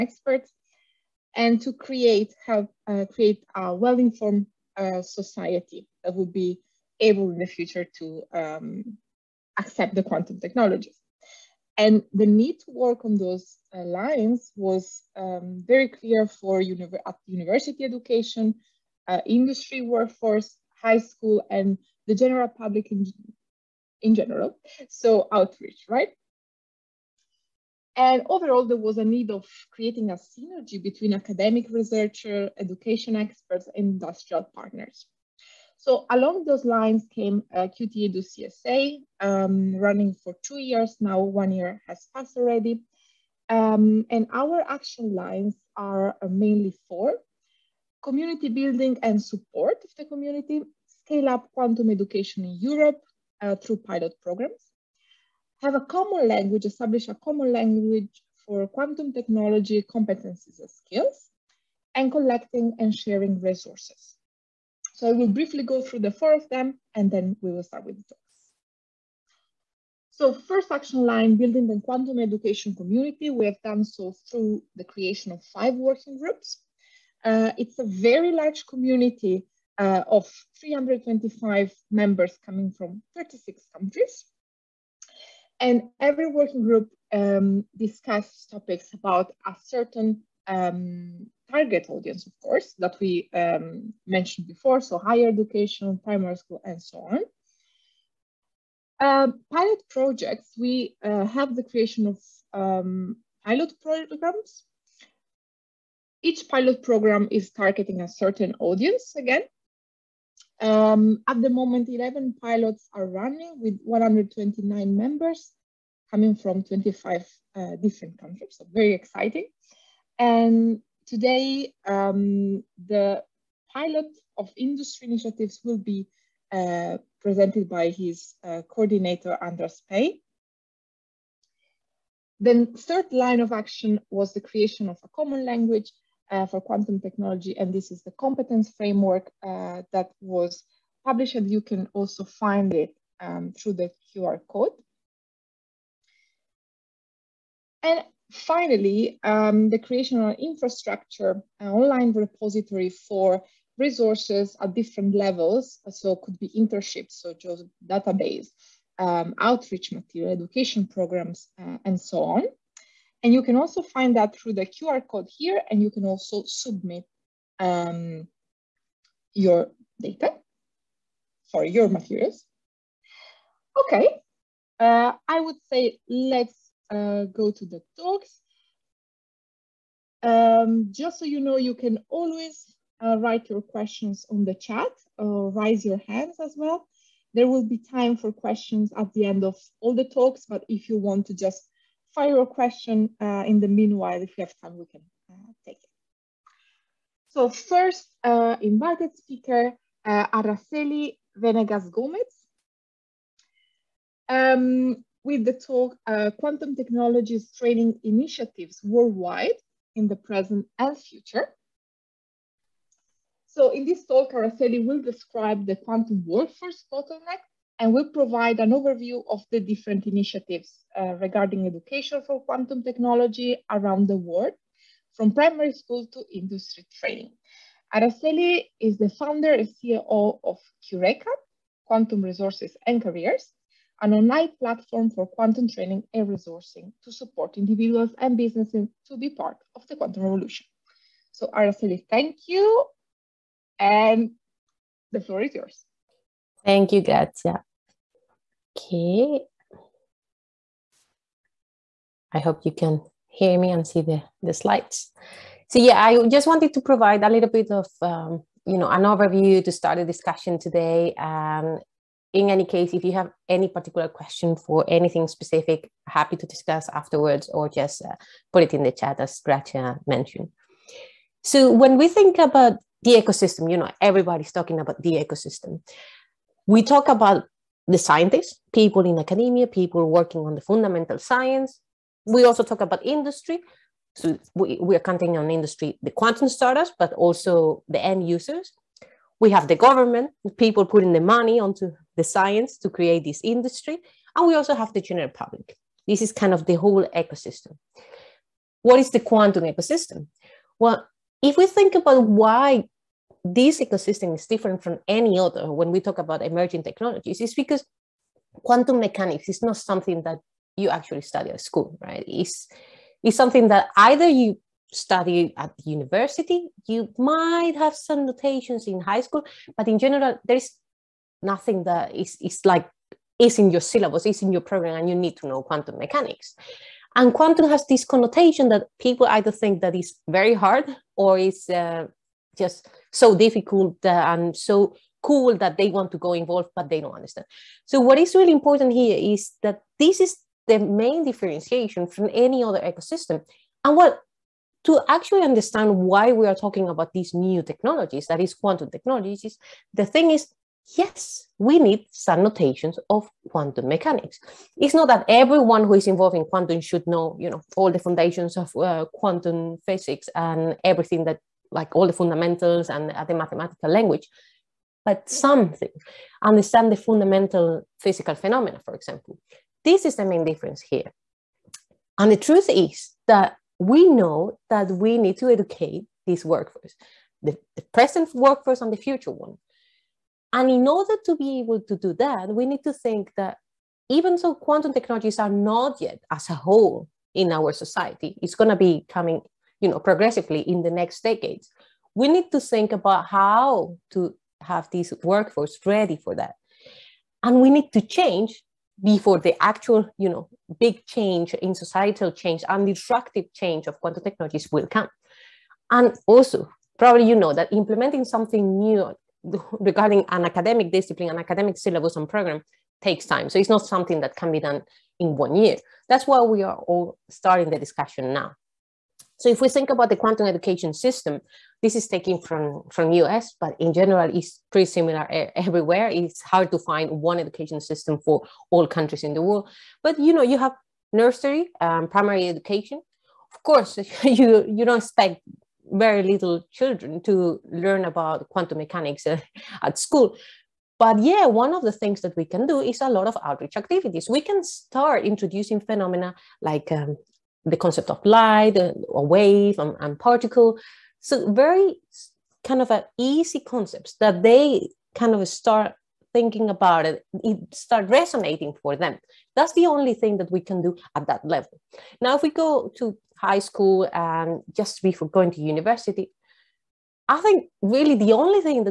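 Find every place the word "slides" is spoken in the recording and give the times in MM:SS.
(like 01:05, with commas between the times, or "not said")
04:14.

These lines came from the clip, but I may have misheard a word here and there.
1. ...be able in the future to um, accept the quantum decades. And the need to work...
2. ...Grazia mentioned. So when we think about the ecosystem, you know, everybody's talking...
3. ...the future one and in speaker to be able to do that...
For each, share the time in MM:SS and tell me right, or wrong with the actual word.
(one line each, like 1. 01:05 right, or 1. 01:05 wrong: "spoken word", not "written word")
1. 00:06 wrong: "technologies", not "decades"
2. 04:29 right
3. 06:18 wrong: "order", not "speaker".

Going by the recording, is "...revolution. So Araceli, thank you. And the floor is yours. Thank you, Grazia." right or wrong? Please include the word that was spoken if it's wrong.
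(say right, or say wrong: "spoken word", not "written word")
right.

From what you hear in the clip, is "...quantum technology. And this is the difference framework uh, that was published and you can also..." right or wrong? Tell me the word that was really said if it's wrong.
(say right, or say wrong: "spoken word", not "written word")
wrong: "competence", not "difference".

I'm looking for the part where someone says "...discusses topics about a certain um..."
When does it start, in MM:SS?
01:27.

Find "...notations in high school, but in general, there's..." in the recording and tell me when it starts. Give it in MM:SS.
05:18.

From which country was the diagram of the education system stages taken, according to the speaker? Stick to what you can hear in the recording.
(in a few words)
US.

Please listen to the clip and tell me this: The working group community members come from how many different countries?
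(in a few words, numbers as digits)
36.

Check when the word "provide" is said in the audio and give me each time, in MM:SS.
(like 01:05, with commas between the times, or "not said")
03:38, 04:16.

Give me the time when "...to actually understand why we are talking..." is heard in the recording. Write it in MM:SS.
05:44.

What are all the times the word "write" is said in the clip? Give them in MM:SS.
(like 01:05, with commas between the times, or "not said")
03:03.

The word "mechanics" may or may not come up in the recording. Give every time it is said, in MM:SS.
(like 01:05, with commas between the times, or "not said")
05:09, 05:25, 05:53, 07:18.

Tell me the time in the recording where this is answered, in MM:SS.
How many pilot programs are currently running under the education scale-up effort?
01:51.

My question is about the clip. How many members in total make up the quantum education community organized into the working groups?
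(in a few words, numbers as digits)
325.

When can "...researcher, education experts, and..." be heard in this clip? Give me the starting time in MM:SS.
00:31.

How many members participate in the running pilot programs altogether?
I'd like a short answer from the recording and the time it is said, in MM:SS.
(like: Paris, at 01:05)
129, at 01:53.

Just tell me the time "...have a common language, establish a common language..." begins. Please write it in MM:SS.
00:55.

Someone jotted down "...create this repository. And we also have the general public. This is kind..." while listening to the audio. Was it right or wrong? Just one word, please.
wrong.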